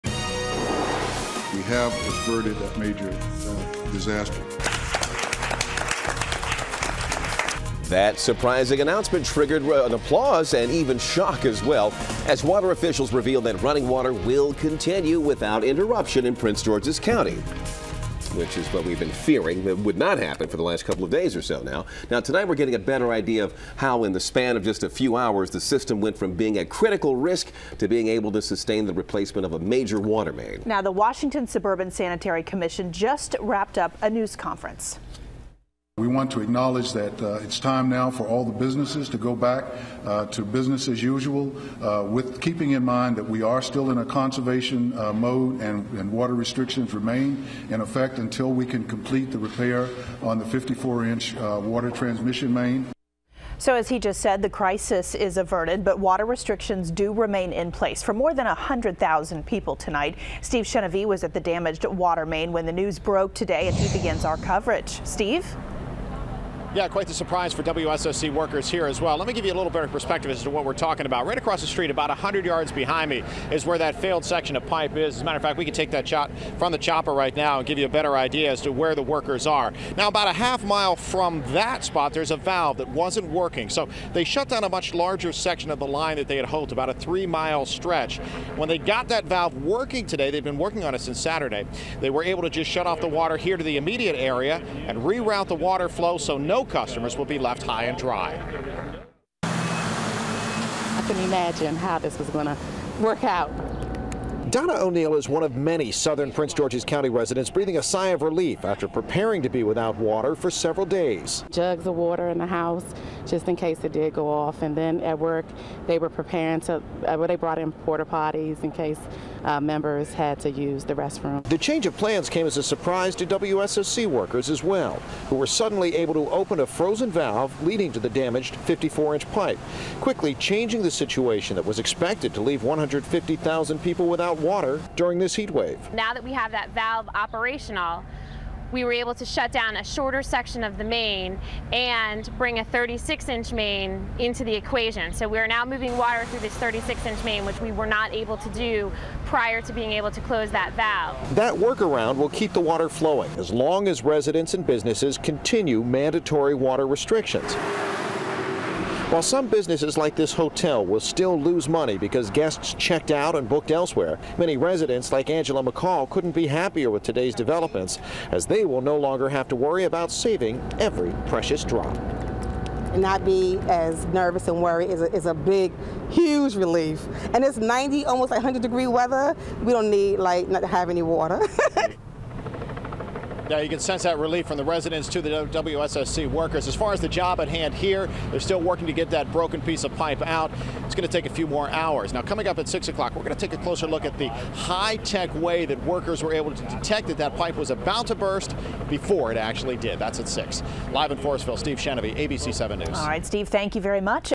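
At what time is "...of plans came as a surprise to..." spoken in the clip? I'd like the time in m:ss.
2:01.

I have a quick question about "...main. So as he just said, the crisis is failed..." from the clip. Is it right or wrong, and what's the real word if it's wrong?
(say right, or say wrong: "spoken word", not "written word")
wrong: "averted", not "failed".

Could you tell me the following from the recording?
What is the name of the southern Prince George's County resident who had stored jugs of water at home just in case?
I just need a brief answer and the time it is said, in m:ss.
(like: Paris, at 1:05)
Donna O'Neill, at 1:44.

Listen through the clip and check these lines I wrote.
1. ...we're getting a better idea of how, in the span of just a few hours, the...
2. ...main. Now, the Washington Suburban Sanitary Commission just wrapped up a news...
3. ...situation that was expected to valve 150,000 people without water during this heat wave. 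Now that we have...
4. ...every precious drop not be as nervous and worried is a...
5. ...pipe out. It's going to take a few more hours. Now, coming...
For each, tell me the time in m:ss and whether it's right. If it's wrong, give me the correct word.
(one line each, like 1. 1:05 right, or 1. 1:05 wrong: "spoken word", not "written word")
1. 0:22 right
2. 0:30 right
3. 2:10 wrong: "leave", not "valve"
4. 2:50 right
5. 3:09 right.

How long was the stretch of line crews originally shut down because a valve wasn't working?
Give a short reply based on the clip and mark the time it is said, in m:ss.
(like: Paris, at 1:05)
three mile, at 1:26.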